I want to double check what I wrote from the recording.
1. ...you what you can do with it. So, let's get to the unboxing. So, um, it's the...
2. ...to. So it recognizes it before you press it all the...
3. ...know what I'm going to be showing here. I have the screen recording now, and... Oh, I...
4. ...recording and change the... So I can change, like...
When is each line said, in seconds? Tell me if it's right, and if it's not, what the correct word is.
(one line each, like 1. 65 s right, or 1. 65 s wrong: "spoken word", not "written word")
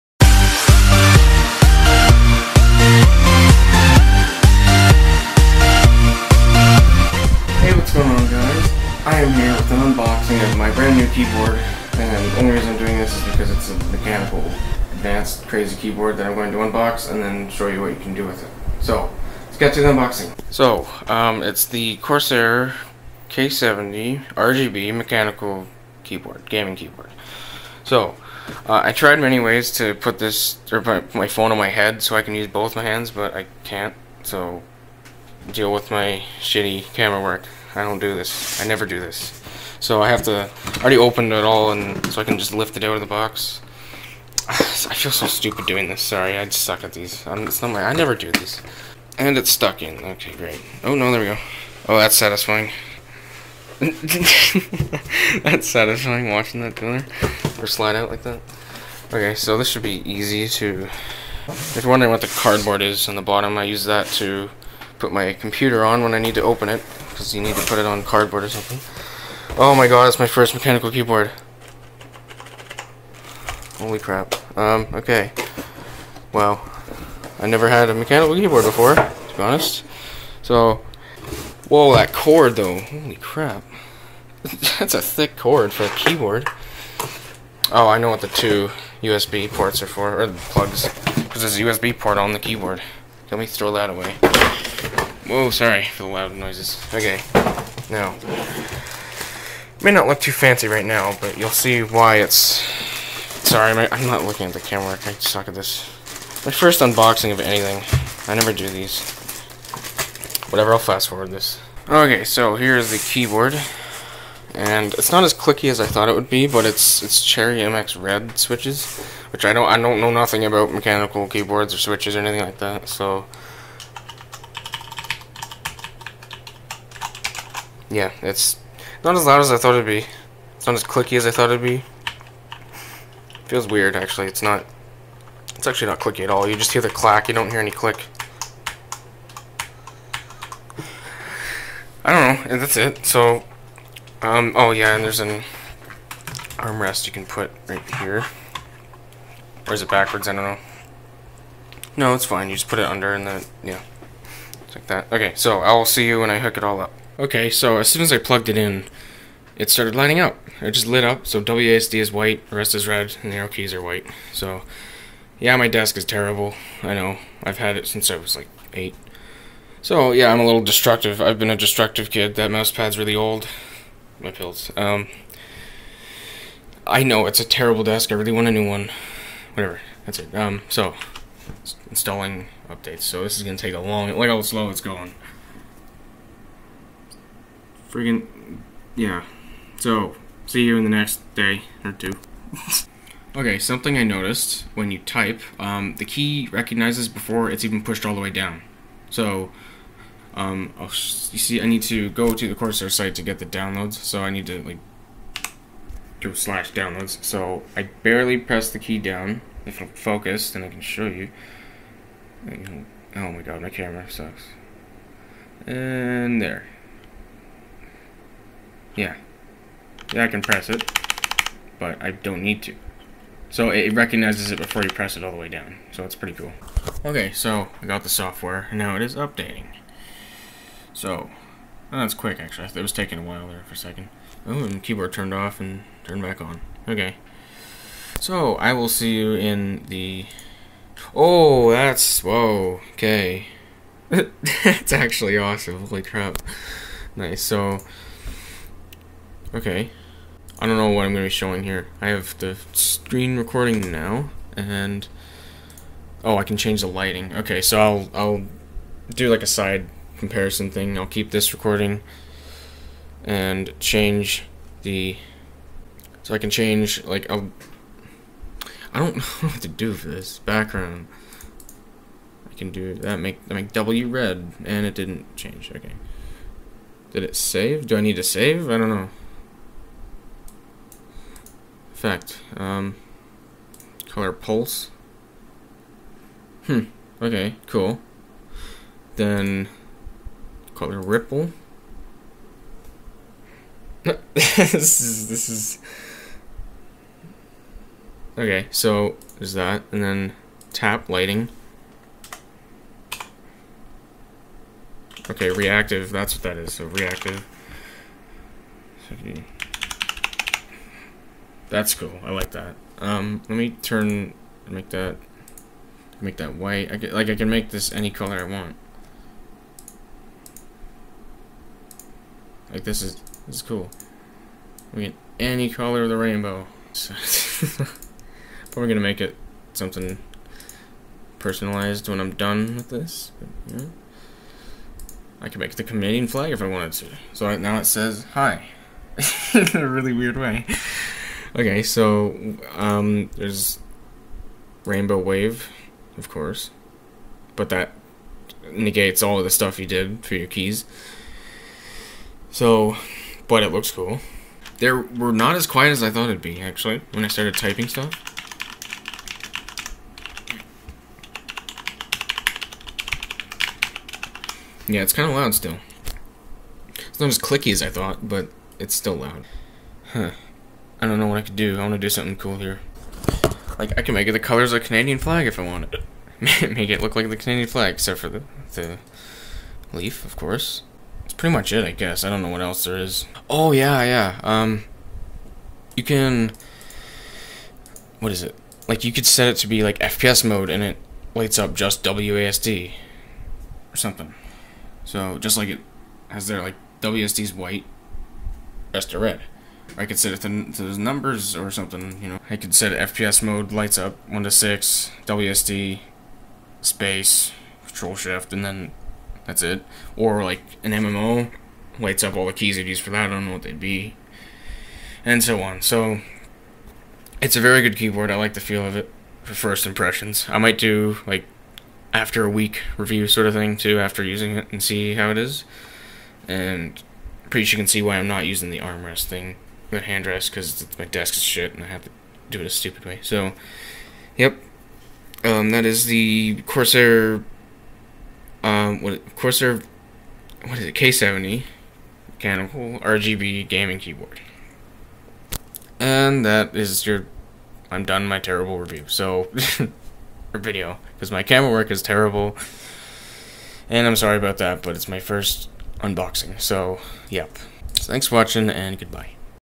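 1. 17 s right
2. 222 s right
3. 250 s right
4. 261 s right.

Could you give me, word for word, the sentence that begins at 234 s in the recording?
Oh, and keyboard turned off and turned back on.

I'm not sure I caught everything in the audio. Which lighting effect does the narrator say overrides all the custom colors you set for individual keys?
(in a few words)
Rainbow Wave.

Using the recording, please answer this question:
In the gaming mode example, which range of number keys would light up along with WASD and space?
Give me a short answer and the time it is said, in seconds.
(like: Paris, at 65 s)
1 to 6, at 404 s.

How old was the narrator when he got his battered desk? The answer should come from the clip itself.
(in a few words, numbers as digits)
8.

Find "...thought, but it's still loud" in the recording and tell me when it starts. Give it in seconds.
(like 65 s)
367 s.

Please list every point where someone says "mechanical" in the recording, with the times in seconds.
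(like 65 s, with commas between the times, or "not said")
13 s, 24 s, 70 s, 77 s, 120 s, 442 s.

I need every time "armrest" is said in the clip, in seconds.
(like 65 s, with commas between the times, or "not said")
146 s, 428 s.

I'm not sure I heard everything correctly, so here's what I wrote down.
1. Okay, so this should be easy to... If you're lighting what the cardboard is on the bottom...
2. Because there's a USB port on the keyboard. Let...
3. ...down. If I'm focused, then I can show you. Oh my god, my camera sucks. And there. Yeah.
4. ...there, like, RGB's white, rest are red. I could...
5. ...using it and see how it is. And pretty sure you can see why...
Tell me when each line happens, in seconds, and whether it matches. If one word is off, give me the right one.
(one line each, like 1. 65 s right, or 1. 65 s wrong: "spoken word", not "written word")
1. 59 s wrong: "wondering", not "lighting"
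2. 91 s right
3. 208 s right
4. 396 s wrong: "WSD", not "RGB"
5. 424 s right.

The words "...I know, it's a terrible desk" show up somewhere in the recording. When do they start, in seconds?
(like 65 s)
176 s.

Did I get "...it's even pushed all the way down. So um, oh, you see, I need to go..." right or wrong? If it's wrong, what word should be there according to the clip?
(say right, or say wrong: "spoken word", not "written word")
right.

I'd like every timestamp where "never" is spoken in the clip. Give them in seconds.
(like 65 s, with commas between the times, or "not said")
38 s, 47 s, 77 s, 108 s.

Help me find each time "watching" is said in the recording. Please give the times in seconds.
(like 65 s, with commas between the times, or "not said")
56 s, 458 s.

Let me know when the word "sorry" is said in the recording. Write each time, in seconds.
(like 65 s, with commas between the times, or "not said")
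46 s, 95 s, 103 s, 454 s.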